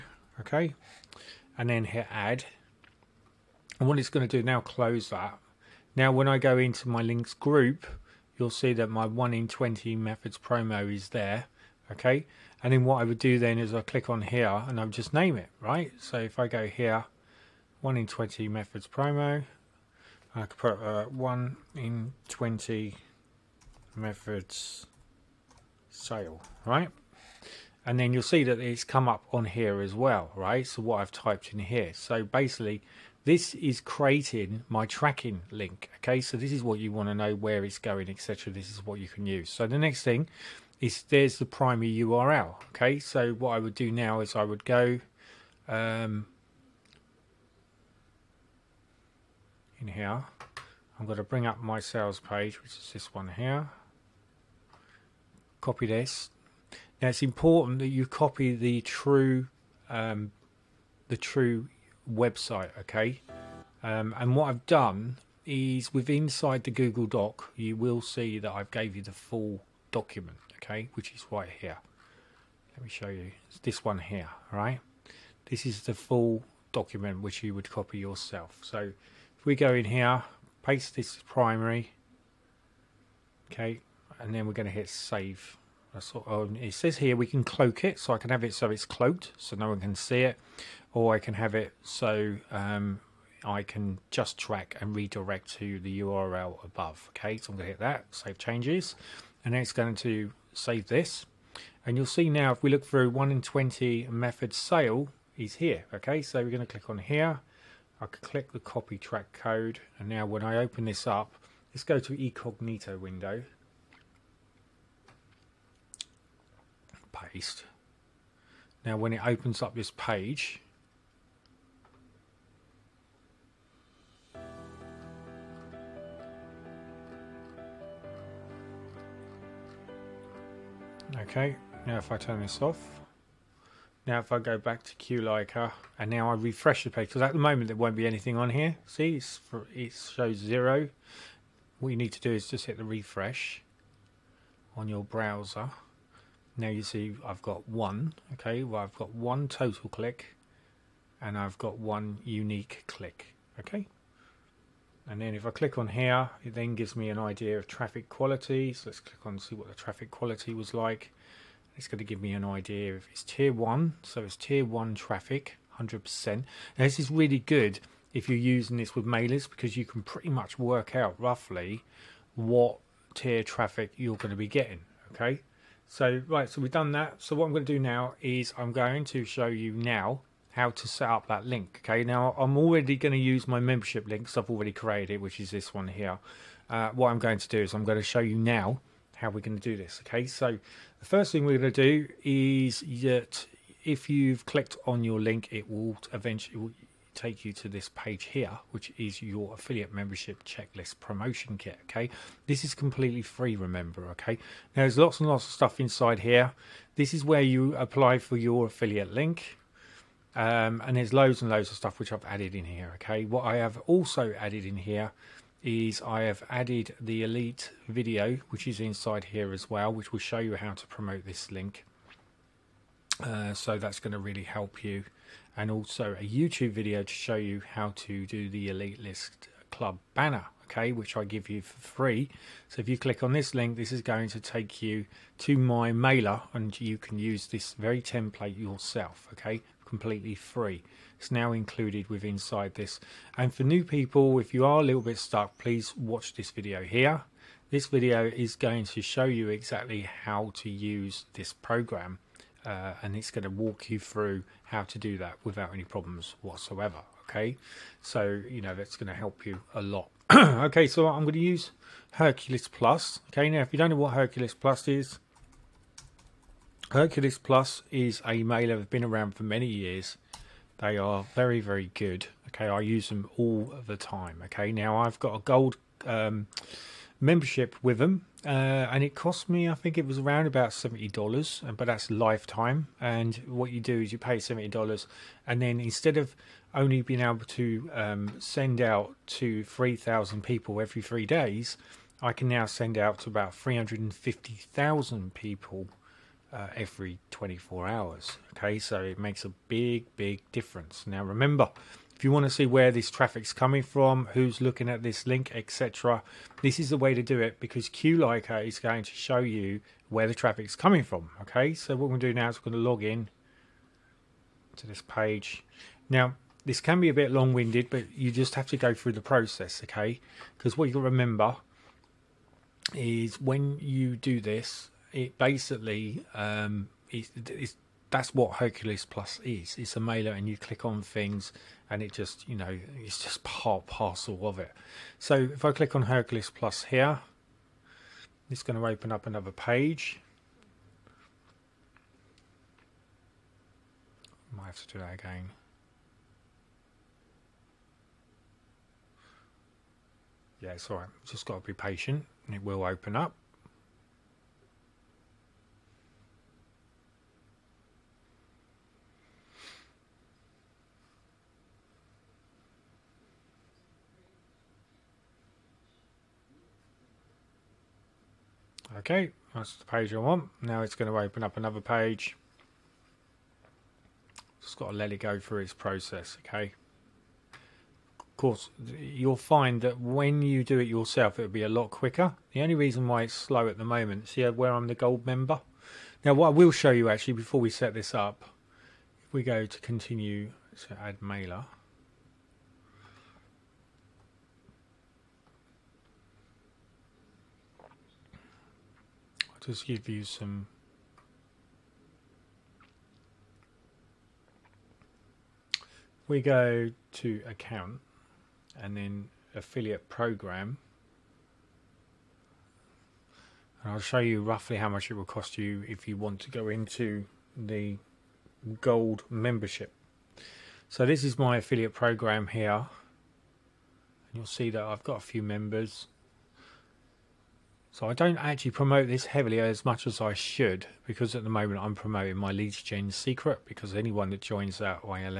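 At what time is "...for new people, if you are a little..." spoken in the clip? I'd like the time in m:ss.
4:03.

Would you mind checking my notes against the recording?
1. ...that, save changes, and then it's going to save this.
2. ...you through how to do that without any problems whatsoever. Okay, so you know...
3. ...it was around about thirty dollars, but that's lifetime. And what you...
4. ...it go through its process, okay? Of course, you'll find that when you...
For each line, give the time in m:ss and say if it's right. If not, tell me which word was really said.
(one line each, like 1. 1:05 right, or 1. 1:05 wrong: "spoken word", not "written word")
1. 1:37 right
2. 4:13 right
3. 4:39 wrong: "seventy", not "thirty"
4. 6:15 right.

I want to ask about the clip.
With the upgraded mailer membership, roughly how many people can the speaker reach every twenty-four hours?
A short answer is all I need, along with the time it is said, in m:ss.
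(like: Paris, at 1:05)
350,000, at 4:53.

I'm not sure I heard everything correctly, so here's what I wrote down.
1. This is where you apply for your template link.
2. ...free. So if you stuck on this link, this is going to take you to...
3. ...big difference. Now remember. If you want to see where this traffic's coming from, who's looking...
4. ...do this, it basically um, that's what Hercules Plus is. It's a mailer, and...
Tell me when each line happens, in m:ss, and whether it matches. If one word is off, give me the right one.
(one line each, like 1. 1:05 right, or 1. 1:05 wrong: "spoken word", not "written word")
1. 3:26 wrong: "affiliate", not "template"
2. 3:51 wrong: "click", not "stuck"
3. 5:00 right
4. 5:24 right.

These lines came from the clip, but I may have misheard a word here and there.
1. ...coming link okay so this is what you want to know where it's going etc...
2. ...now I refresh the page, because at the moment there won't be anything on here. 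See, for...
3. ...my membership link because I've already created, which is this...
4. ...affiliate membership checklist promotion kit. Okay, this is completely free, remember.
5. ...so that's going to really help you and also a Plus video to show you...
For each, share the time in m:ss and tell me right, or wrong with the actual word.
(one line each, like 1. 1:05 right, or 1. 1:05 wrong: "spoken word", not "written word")
1. 0:34 wrong: "tracking", not "coming"
2. 2:16 right
3. 3:03 right
4. 3:19 right
5. 3:43 wrong: "YouTube", not "Plus".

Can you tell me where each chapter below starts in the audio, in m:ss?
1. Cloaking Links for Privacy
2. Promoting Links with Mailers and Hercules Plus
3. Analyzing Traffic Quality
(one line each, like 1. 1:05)
1. 1:26
2. 4:26
3. 2:35.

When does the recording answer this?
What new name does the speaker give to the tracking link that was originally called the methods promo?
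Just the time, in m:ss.
0:21.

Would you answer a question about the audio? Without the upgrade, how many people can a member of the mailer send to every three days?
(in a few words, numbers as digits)
3,000.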